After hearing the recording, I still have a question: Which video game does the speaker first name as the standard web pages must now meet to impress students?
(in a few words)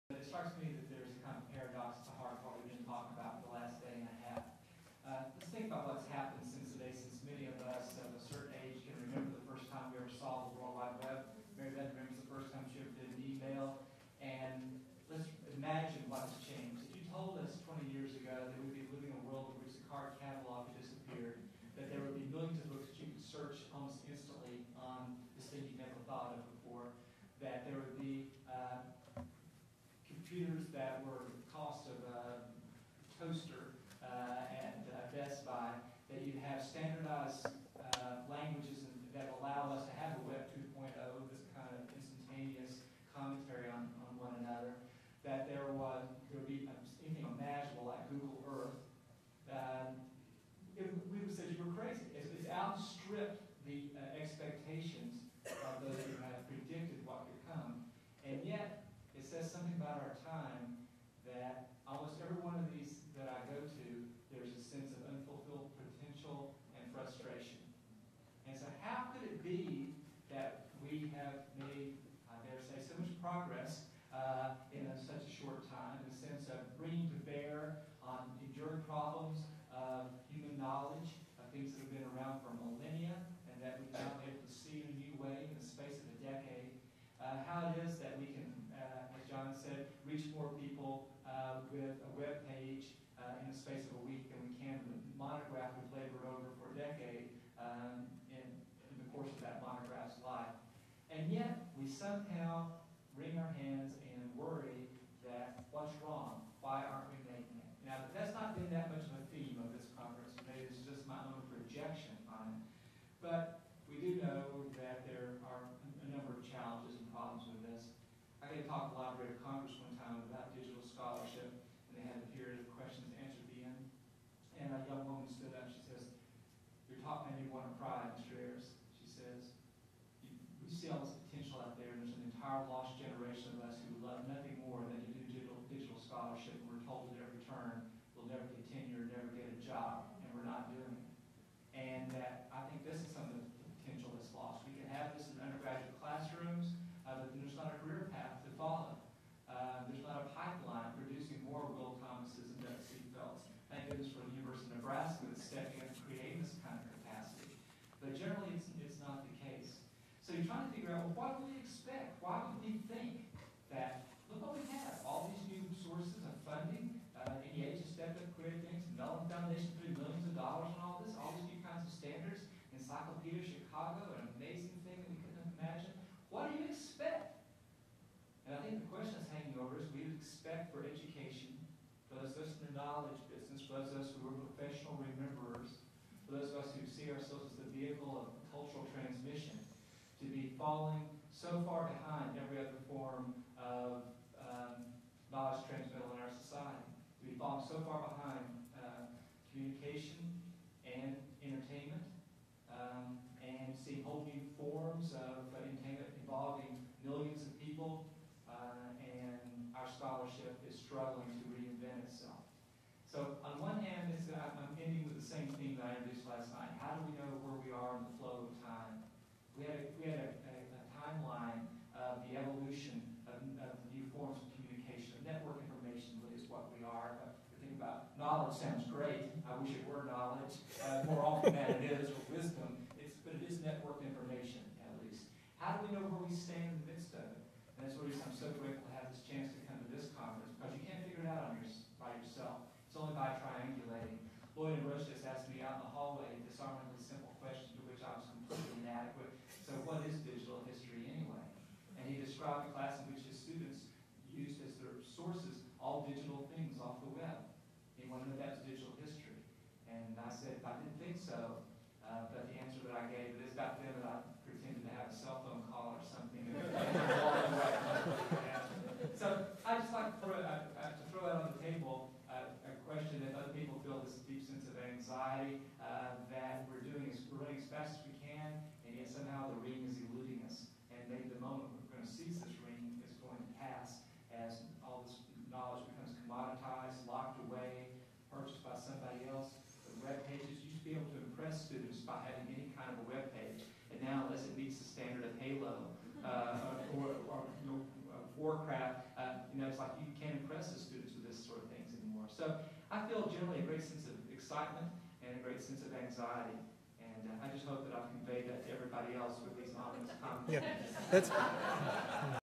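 Halo.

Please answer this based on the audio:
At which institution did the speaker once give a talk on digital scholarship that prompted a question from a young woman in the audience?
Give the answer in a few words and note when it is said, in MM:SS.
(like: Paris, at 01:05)
Library of Congress, at 01:59.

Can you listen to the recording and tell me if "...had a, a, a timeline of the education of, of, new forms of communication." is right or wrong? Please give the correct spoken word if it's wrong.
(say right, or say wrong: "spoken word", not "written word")
wrong: "evolution", not "education".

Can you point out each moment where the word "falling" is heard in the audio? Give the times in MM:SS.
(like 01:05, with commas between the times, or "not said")
03:10, 03:17.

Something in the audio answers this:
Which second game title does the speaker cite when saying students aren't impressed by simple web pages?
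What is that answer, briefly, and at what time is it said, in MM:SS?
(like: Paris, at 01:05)
Warcraft, at 04:58.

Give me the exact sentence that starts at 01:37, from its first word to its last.
Um, And yet, we somehow wring our hands and worry that what's wrong?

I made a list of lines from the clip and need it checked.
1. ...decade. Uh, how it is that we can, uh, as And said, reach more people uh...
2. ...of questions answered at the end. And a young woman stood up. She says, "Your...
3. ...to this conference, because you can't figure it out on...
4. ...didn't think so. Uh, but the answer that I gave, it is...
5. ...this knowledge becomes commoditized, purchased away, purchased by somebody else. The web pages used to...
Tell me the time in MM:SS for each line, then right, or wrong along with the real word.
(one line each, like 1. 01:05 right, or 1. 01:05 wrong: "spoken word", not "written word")
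1. 01:26 wrong: "John", not "And"
2. 02:02 right
3. 03:59 right
4. 04:20 right
5. 04:45 wrong: "locked", not "purchased".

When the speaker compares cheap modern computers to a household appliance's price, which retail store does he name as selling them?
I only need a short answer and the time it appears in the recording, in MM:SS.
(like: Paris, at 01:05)
Best Buy, at 00:35.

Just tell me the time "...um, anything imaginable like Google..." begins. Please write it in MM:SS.
00:46.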